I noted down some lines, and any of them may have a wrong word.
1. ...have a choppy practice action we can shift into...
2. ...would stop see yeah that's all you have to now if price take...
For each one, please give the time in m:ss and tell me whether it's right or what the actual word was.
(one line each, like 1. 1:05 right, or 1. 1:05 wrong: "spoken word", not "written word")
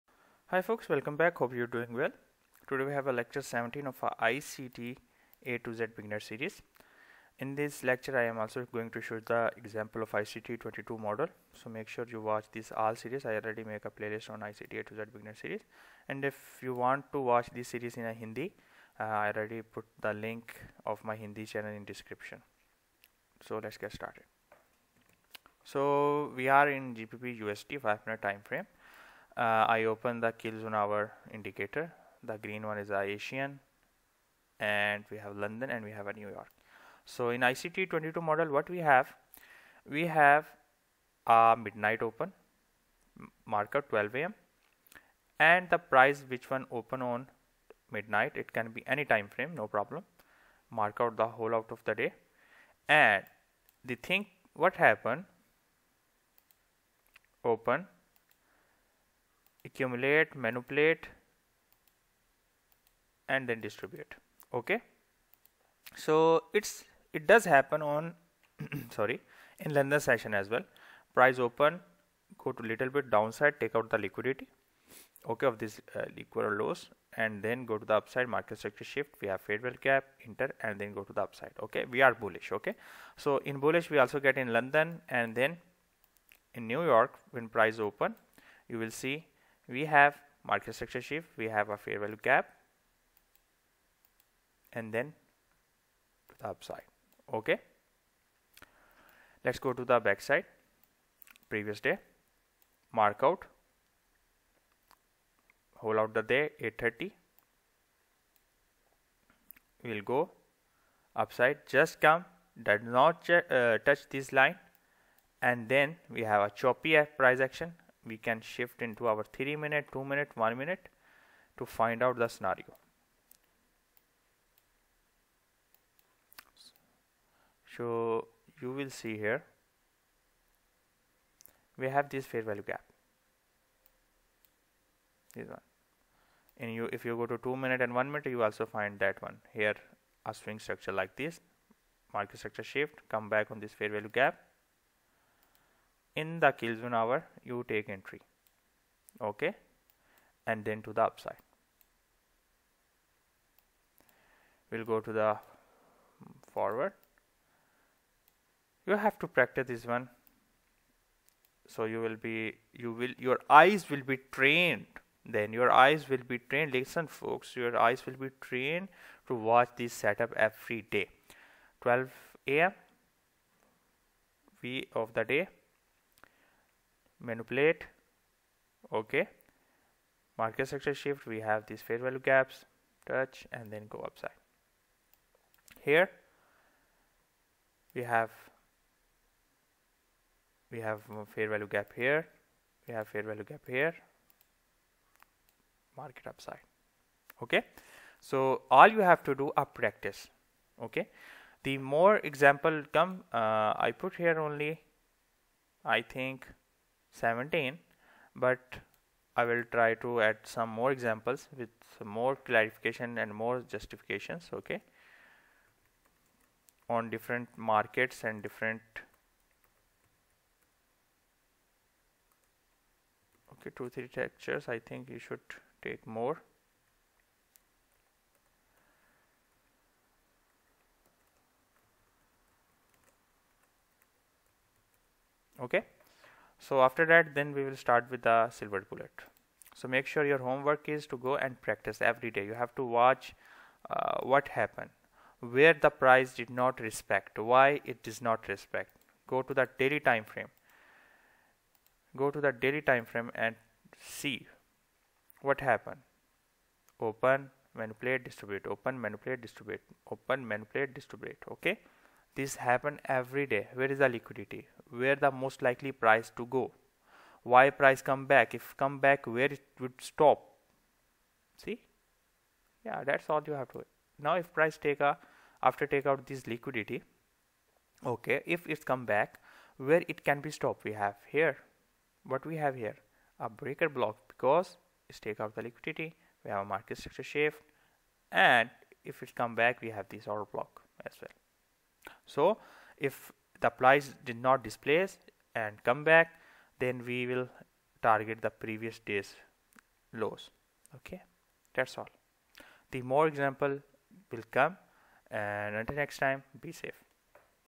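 1. 1:56 wrong: "price", not "practice"
2. 4:29 right.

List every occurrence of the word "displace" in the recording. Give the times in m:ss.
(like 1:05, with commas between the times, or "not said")
4:54.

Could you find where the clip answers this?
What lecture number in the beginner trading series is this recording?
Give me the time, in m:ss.
0:03.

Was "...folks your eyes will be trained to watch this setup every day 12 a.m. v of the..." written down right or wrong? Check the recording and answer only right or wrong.
right.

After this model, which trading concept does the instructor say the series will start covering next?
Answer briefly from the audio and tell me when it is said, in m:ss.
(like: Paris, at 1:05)
silver bullet, at 3:58.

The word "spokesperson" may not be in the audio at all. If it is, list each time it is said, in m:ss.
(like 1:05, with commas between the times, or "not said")
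not said.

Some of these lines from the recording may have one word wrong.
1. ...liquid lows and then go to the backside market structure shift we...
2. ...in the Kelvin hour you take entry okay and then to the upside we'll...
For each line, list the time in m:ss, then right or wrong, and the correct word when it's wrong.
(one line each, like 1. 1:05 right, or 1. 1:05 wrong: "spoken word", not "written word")
1. 1:16 wrong: "upside", not "backside"
2. 2:26 right.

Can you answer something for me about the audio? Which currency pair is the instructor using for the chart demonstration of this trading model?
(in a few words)
GBP USD.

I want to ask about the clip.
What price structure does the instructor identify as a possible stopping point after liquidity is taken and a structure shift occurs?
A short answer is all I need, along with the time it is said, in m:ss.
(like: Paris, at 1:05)
breaker block, at 4:43.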